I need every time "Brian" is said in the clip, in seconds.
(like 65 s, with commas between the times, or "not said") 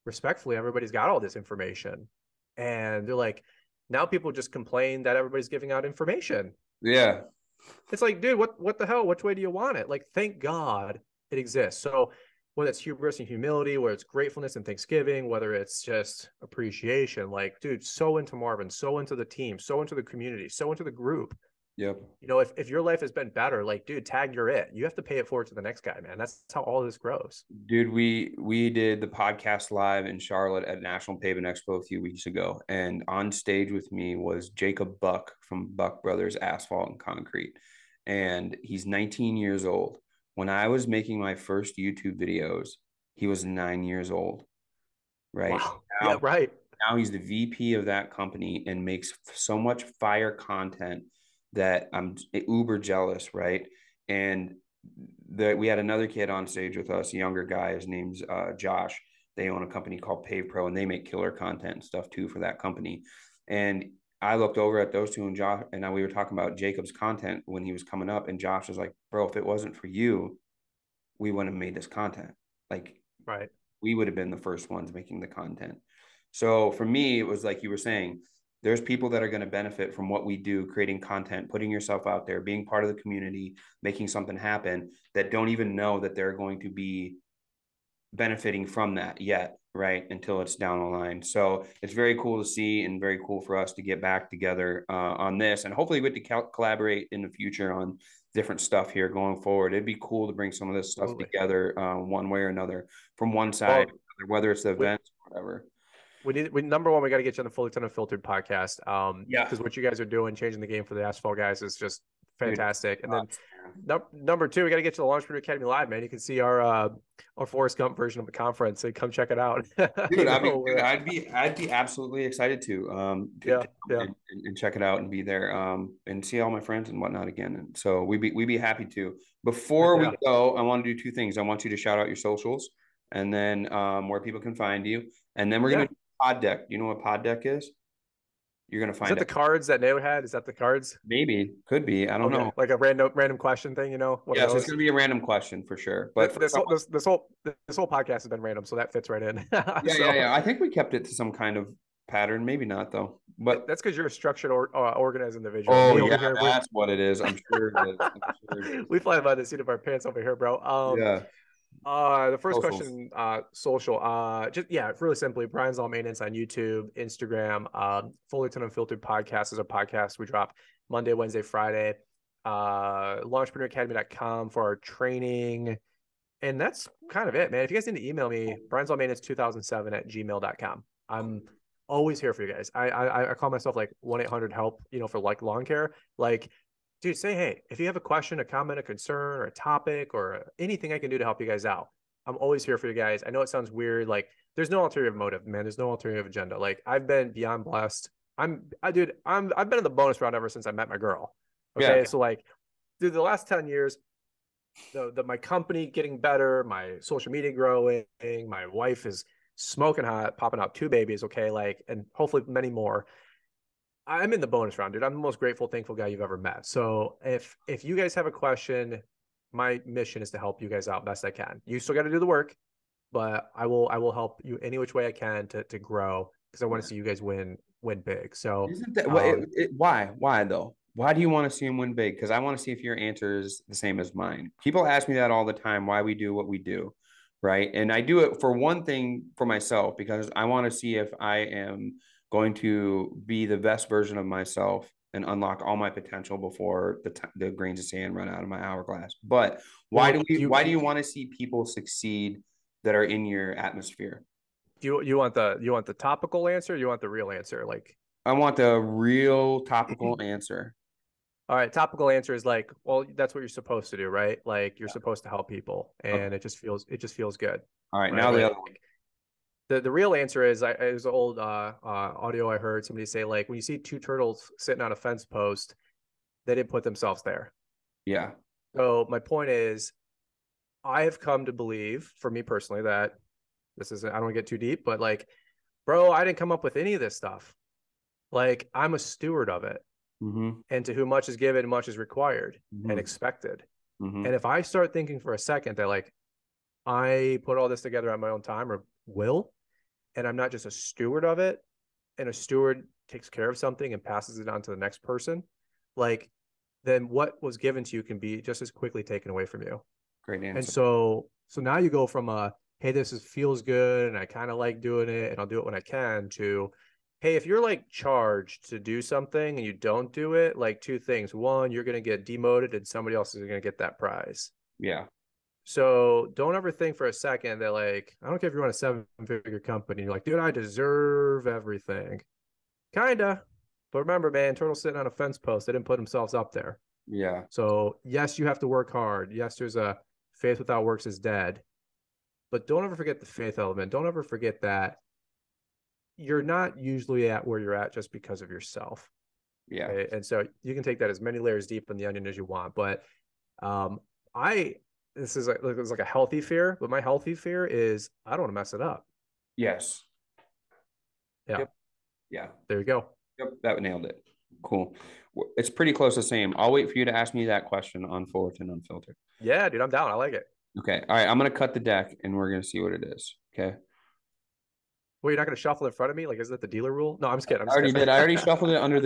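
165 s, 178 s.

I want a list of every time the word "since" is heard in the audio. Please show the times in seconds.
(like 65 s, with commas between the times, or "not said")
200 s.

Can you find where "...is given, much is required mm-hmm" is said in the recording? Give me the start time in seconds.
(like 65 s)
291 s.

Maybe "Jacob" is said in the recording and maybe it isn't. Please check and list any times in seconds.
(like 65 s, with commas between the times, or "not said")
34 s, 66 s.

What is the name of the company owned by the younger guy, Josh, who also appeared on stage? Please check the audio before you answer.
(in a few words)
Pave Pro.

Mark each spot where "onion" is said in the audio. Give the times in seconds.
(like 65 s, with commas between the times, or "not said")
352 s.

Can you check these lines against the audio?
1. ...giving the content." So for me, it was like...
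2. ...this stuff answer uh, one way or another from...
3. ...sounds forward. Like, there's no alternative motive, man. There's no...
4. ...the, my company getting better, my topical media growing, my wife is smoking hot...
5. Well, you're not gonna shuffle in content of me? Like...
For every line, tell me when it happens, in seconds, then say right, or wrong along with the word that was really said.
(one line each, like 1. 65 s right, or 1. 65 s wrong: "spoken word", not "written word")
1. 74 s wrong: "making", not "giving"
2. 100 s wrong: "together", not "answer"
3. 193 s wrong: "weird", not "forward"
4. 205 s wrong: "social", not "topical"
5. 375 s wrong: "front", not "content".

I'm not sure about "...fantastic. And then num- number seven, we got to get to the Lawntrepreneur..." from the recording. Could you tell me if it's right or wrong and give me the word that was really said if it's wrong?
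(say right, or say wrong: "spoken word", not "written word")
wrong: "two", not "seven".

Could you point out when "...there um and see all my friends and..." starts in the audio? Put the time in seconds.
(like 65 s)
125 s.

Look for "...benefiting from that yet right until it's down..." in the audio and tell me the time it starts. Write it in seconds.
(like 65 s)
88 s.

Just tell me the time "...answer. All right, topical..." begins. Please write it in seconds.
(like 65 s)
260 s.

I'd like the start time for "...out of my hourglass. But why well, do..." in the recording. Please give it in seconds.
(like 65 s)
248 s.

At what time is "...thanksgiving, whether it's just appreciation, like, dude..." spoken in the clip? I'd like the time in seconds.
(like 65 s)
14 s.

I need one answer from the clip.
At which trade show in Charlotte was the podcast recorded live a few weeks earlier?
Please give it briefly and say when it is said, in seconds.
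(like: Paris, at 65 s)
National Pavement Expo, at 30 s.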